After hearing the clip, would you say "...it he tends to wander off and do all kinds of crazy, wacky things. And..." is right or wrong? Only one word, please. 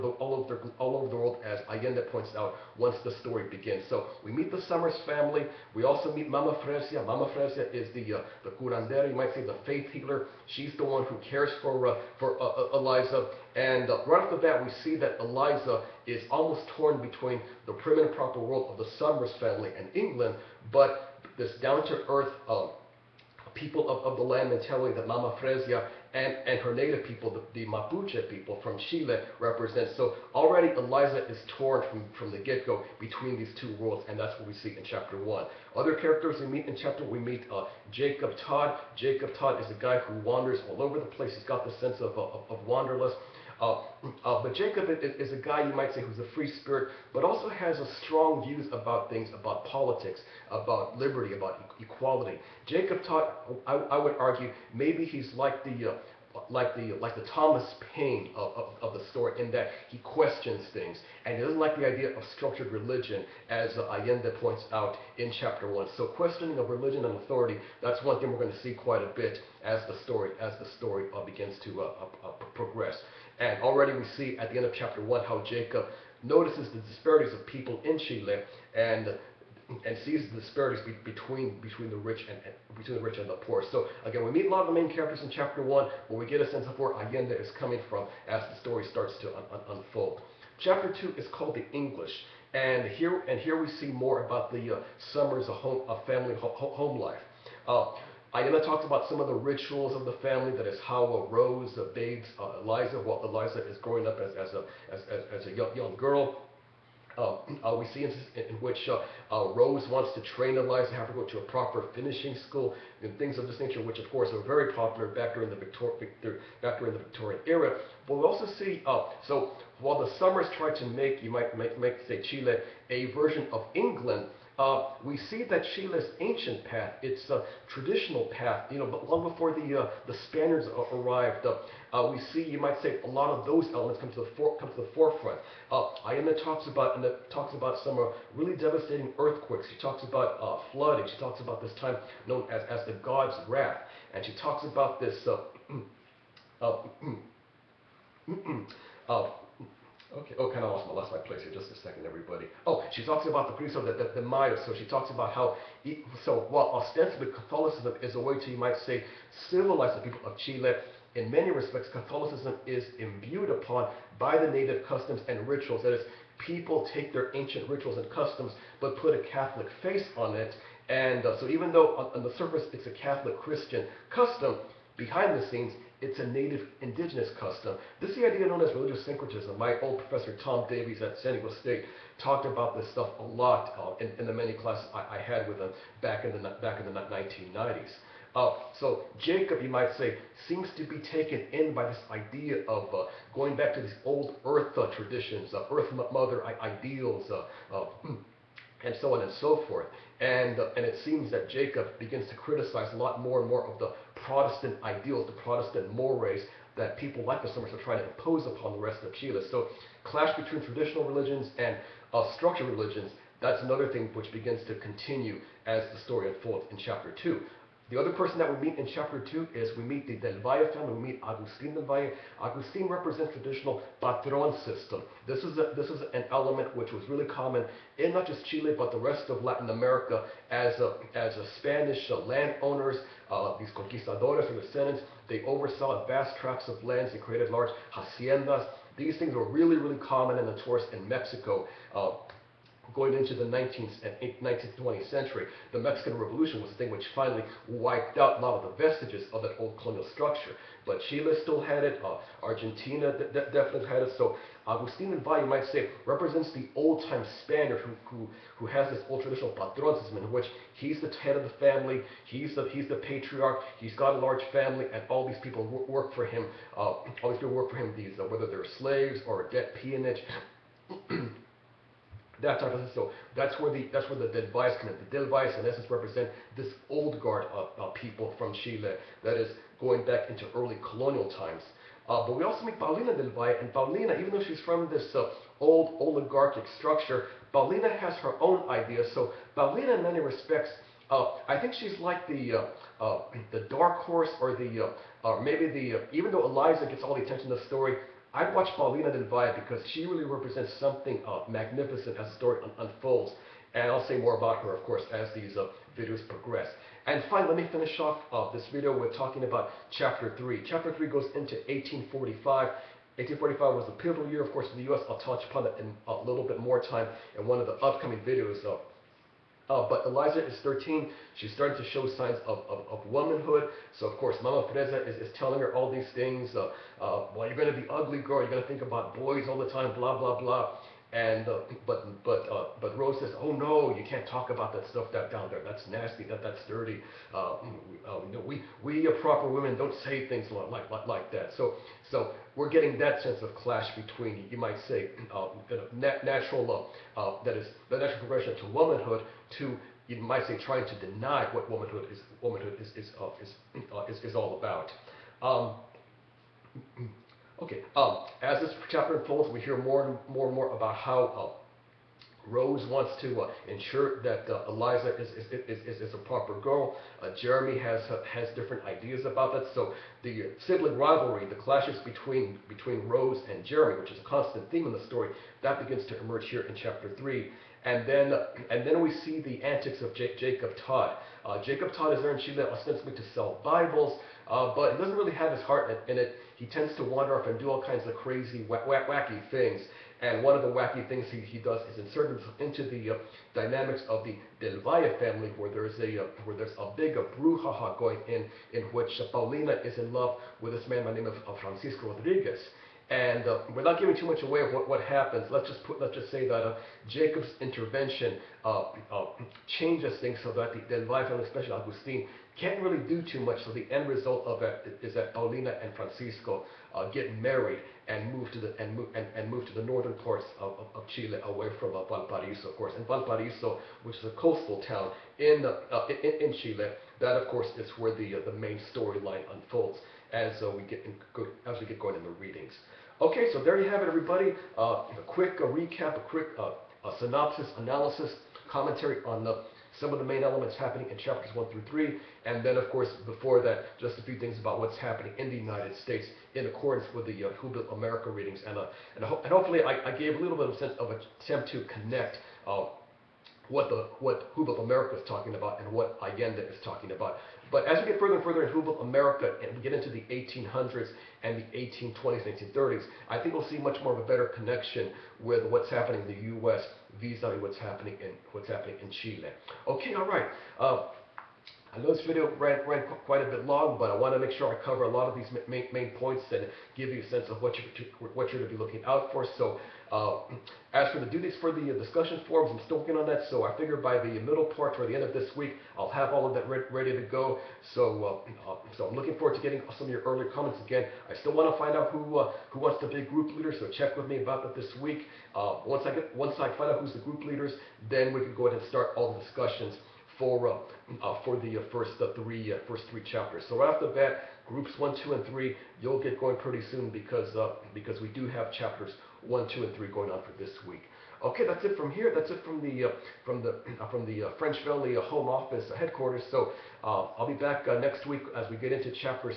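right.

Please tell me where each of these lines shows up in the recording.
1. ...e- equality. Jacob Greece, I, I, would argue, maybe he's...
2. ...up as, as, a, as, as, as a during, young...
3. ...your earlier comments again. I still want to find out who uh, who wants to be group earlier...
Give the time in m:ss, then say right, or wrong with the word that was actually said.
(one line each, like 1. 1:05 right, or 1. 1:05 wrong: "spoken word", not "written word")
1. 0:51 wrong: "Todd", not "Greece"
2. 1:44 wrong: "young", not "during"
3. 8:10 wrong: "leader", not "earlier".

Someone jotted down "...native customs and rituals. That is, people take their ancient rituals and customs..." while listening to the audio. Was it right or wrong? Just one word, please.
right.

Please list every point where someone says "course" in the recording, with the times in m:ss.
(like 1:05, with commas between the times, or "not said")
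1:54, 5:04, 5:14, 5:24, 7:02, 7:07, 7:22.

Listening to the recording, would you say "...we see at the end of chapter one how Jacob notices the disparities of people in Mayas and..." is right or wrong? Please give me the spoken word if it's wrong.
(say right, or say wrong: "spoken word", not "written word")
wrong: "Chile", not "Mayas".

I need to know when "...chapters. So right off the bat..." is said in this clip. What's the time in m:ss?
8:23.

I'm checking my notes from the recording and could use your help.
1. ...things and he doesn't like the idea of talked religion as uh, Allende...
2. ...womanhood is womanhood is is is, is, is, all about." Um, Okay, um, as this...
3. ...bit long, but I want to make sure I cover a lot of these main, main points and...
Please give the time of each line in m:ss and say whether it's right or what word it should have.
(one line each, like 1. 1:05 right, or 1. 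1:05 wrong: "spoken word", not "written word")
1. 1:00 wrong: "structured", not "talked"
2. 5:51 right
3. 7:53 right.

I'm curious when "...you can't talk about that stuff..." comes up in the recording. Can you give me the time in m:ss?
5:33.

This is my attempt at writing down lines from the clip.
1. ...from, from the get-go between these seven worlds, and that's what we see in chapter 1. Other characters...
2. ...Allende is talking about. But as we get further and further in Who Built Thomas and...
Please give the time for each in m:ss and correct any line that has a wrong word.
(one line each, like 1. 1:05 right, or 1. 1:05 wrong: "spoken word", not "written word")
1. 0:31 wrong: "two", not "seven"
2. 7:36 wrong: "America", not "Thomas".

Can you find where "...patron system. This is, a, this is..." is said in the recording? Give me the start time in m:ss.
3:44.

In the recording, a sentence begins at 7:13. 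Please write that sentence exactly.
Okay, so there you have it, everybody.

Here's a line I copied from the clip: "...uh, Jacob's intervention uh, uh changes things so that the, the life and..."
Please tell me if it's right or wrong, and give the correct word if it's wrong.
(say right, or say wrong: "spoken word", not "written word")
right.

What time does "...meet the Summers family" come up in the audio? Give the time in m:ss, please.
0:04.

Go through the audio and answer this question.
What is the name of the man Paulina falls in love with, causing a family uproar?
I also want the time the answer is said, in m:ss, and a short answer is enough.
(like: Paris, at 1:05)
Francisco Rodriguez, at 6:41.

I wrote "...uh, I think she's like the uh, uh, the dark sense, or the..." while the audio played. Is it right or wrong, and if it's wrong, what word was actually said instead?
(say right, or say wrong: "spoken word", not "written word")
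wrong: "horse", not "sense".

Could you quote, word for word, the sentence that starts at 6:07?
Uh, Jeremy has uh, has different ideas about that.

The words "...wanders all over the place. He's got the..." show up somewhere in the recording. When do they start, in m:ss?
0:40.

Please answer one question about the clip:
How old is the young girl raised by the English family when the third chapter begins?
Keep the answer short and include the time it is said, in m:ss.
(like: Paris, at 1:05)
13, at 5:20.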